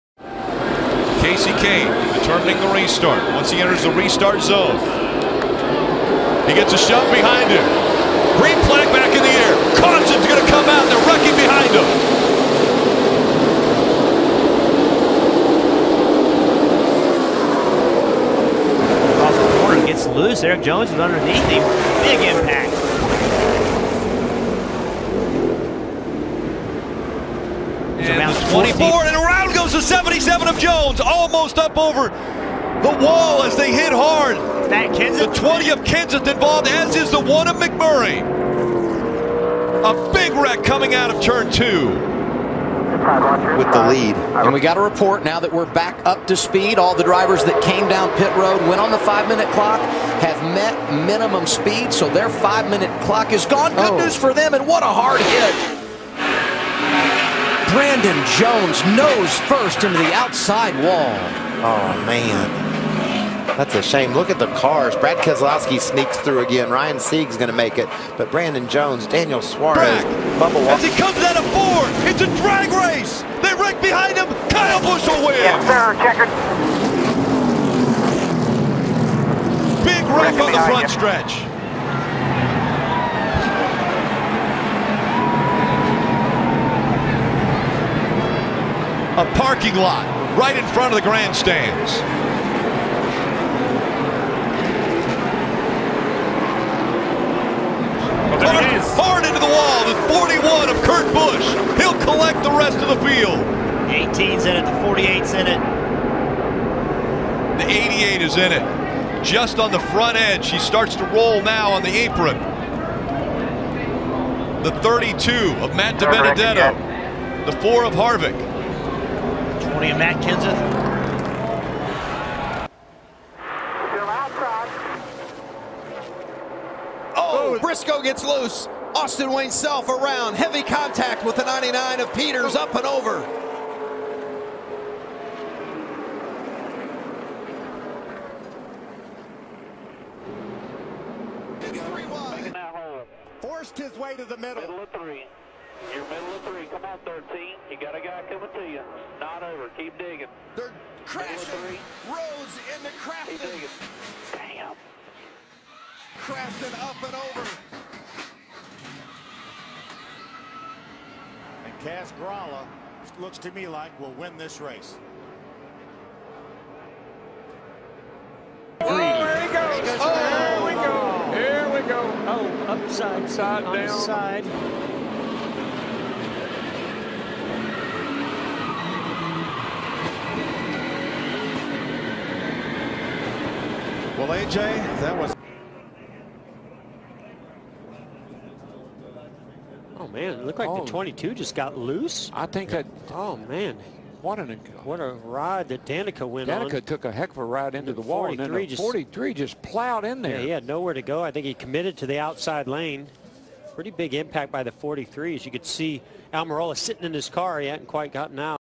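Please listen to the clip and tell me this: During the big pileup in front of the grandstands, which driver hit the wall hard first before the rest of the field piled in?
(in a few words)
Kurt Busch.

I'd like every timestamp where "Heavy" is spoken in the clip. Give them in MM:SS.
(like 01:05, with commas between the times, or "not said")
02:10.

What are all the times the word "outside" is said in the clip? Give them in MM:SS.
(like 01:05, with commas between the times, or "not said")
01:00, 03:22.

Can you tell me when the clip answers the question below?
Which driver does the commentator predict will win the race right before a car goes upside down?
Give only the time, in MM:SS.
02:41.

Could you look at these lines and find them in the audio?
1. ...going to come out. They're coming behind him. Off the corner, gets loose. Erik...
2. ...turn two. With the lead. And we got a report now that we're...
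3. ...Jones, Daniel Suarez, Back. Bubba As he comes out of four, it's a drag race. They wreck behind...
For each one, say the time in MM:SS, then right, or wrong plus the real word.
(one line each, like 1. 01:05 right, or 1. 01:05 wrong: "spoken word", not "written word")
1. 00:10 wrong: "wrecking", not "coming"
2. 00:41 right
3. 01:08 right.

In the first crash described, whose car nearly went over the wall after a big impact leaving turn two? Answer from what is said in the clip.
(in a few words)
Erik Jones.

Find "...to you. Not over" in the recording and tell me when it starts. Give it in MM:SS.
02:28.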